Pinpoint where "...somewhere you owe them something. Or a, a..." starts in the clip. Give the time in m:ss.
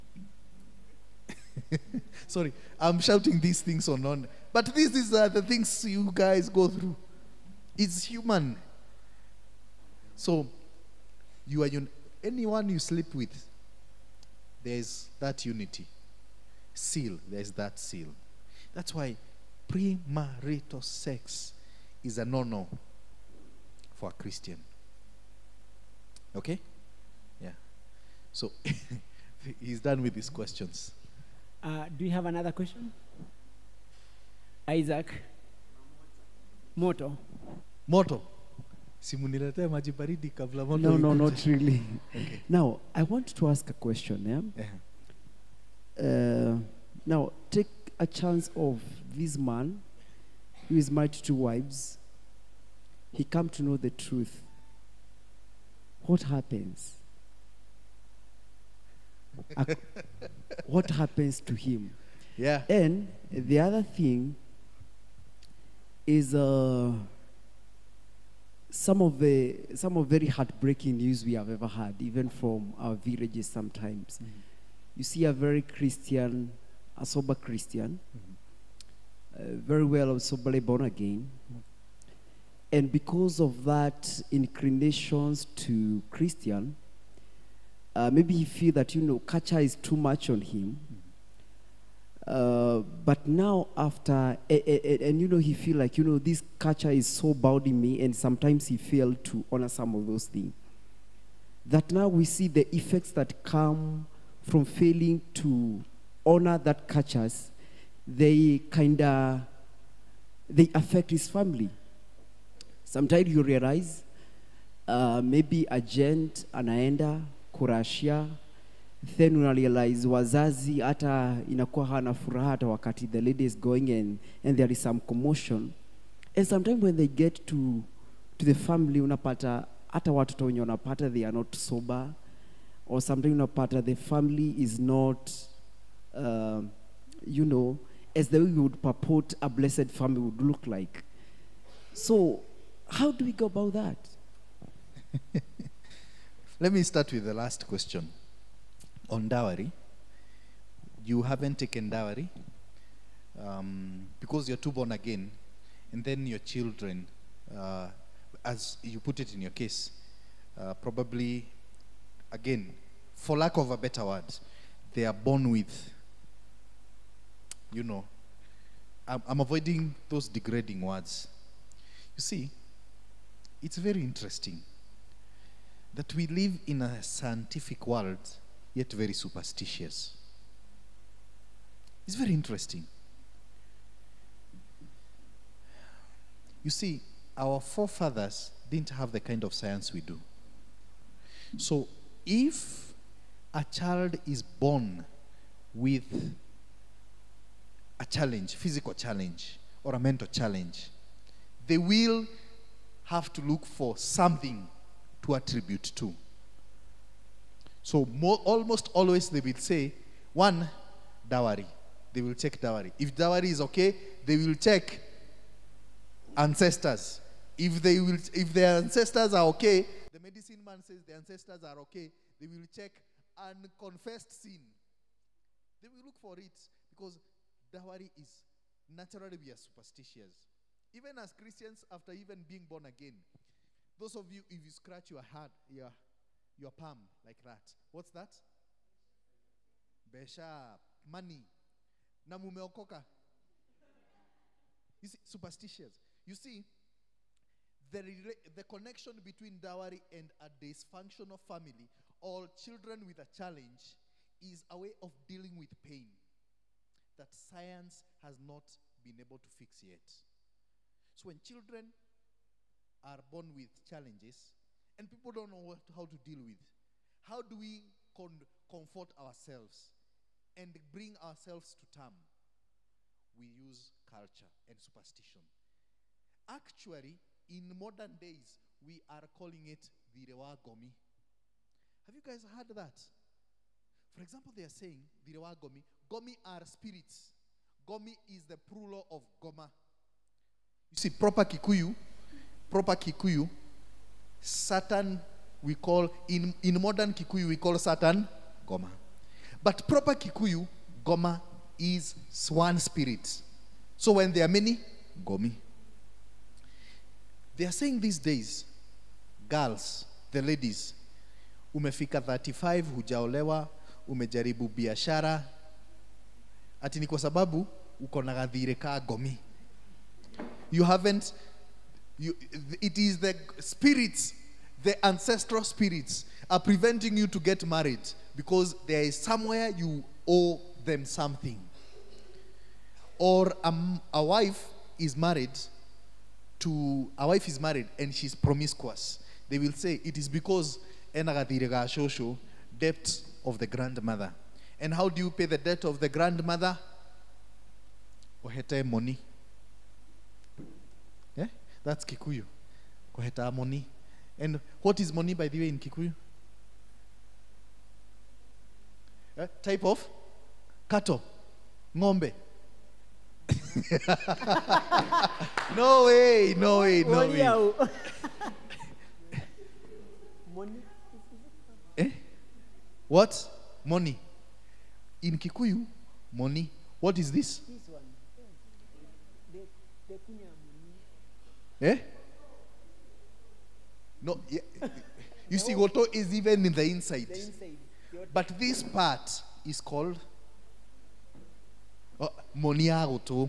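5:29.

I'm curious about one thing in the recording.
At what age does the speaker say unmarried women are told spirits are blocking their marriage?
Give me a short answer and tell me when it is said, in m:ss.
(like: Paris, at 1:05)
35, at 5:12.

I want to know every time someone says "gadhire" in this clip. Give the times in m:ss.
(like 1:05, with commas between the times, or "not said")
5:18.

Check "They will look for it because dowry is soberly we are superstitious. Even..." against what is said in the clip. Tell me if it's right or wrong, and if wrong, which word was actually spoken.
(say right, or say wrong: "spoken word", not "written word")
wrong: "naturally", not "soberly".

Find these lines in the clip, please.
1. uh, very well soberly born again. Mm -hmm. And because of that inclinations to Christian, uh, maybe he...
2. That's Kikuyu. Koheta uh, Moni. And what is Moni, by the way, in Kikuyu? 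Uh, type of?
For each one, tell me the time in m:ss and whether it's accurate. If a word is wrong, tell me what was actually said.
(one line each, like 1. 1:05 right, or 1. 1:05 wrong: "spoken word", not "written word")
1. 1:19 right
2. 5:51 right.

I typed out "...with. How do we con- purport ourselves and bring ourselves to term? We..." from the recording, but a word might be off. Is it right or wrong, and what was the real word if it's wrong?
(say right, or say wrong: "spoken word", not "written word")
wrong: "comfort", not "purport".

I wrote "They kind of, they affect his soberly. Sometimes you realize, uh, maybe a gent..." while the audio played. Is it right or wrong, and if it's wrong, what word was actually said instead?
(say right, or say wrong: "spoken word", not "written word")
wrong: "family", not "soberly".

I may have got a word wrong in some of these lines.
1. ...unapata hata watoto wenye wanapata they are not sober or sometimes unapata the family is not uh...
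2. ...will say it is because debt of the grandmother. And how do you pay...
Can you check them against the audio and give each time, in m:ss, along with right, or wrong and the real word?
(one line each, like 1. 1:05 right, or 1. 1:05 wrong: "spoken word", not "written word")
1. 2:08 right
2. 5:39 right.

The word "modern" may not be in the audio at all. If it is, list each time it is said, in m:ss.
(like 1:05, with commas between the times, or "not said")
4:37, 4:56.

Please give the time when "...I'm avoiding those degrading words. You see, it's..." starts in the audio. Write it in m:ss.
2:49.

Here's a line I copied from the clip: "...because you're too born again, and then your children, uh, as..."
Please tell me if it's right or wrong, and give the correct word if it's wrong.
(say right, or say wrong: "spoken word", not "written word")
right.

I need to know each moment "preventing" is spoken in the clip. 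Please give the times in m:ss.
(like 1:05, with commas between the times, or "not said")
5:26.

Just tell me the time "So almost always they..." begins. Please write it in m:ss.
3:27.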